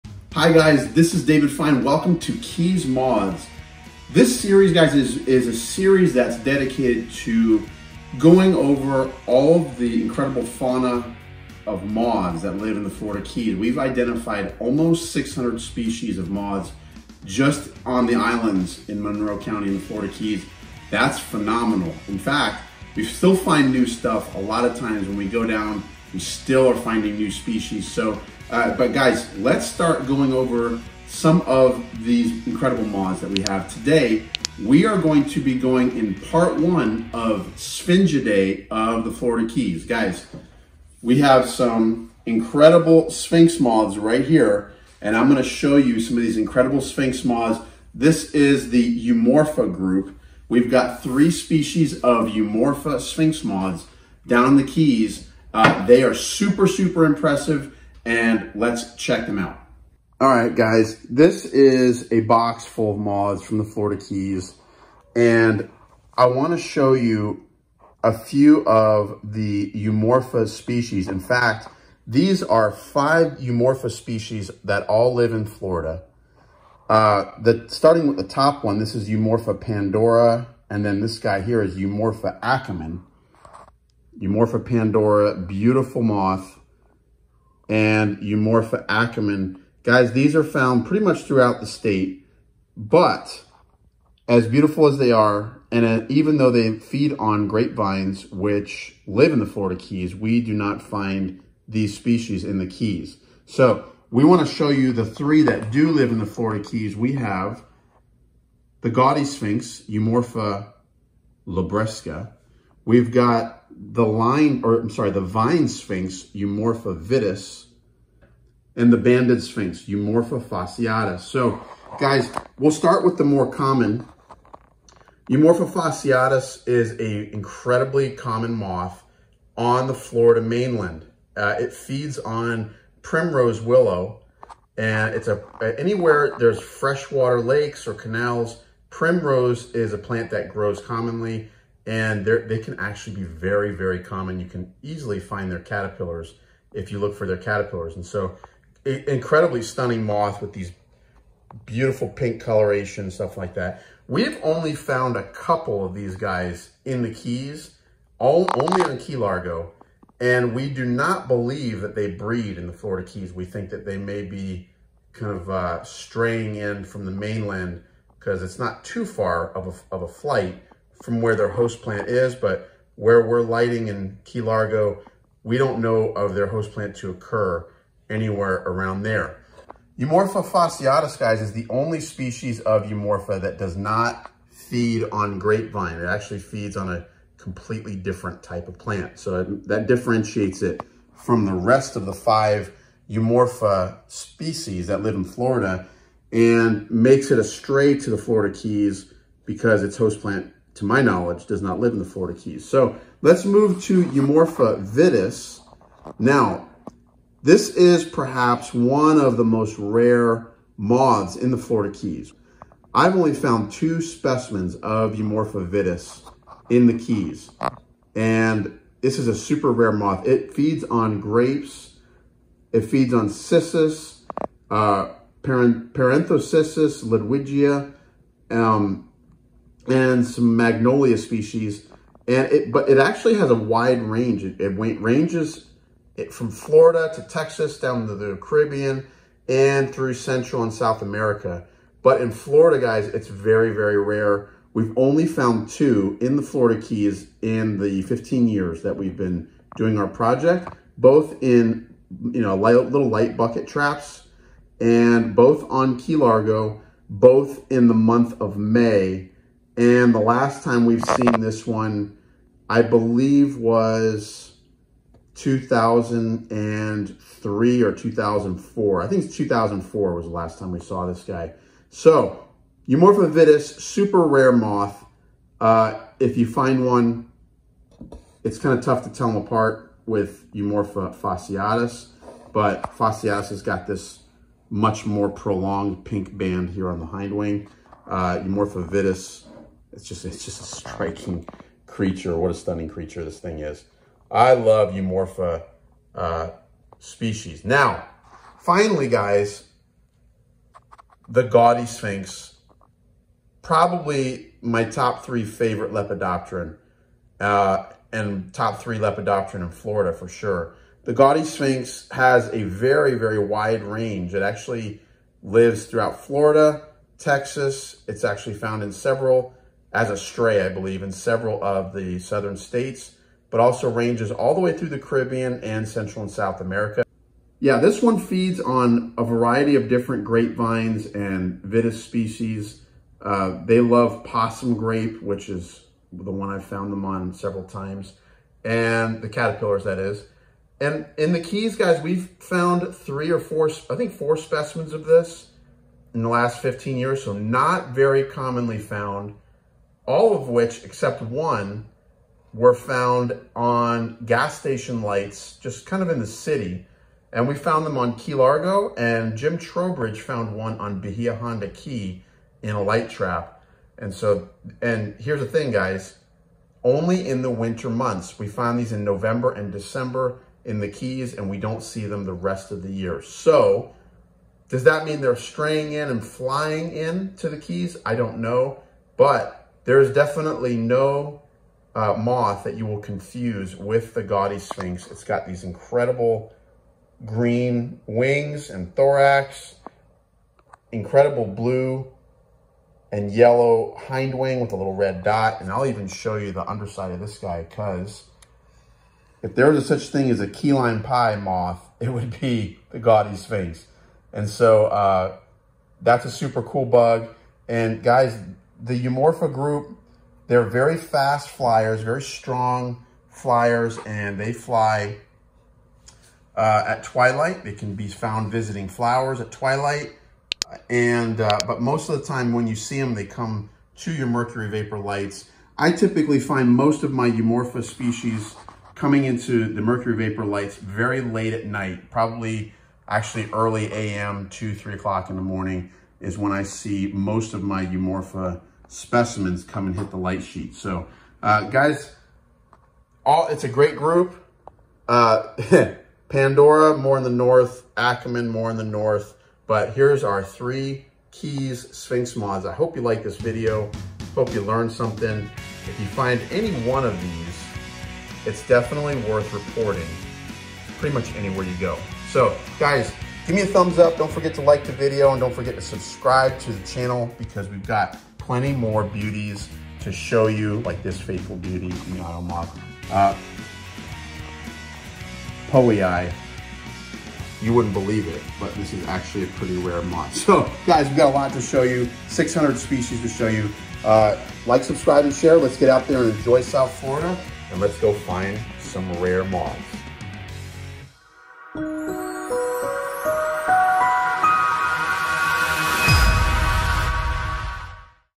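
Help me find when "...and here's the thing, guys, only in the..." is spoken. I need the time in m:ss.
6:04.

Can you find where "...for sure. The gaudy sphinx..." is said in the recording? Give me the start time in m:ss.
5:10.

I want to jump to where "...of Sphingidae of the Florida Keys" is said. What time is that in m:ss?
0:37.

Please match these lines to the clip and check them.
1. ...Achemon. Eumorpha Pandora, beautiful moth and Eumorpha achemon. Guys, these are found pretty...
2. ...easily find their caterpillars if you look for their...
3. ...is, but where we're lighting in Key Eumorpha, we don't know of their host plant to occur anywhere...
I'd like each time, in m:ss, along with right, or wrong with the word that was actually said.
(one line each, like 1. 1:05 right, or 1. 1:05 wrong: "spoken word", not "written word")
1. 1:22 right
2. 2:24 right
3. 2:52 wrong: "Largo", not "Eumorpha".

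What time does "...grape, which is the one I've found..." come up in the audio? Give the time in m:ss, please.
5:34.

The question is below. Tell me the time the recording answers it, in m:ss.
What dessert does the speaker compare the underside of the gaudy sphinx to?
6:40.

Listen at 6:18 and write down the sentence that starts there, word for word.
I don't know, but there is definitely no uh, moth that you will confuse with the gaudy sphinx.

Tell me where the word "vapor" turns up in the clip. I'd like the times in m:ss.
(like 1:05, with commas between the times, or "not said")
7:04, 7:10.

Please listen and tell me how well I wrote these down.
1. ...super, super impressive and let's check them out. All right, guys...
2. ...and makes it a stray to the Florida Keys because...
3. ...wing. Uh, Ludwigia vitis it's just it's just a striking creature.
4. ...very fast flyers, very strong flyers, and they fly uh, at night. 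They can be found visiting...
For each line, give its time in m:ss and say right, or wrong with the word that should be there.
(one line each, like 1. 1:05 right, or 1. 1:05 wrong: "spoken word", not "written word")
1. 0:56 right
2. 3:16 right
3. 4:47 wrong: "Eumorpha", not "Ludwigia"
4. 6:50 wrong: "twilight", not "night".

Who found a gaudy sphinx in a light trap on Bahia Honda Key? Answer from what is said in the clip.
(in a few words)
Jim Trowbridge.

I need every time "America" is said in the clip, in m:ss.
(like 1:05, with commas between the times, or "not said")
4:01, 5:26.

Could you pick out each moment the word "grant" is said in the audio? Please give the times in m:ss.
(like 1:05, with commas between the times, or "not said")
not said.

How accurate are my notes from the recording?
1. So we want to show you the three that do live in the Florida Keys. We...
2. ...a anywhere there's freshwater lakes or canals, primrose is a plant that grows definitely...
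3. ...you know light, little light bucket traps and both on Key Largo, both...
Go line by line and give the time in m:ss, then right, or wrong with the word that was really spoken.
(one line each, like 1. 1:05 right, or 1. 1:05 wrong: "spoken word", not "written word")
1. 1:43 right
2. 2:15 wrong: "commonly", not "definitely"
3. 4:12 right.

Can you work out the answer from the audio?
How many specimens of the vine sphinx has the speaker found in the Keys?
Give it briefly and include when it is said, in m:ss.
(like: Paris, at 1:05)
2, at 3:33.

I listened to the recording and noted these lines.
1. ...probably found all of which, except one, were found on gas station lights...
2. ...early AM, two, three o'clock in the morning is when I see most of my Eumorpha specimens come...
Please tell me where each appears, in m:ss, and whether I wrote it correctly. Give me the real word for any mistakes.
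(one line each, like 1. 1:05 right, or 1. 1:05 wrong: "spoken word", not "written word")
1. 5:48 wrong: "commonly", not "probably"
2. 7:13 right.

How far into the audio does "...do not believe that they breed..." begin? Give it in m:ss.
2:40.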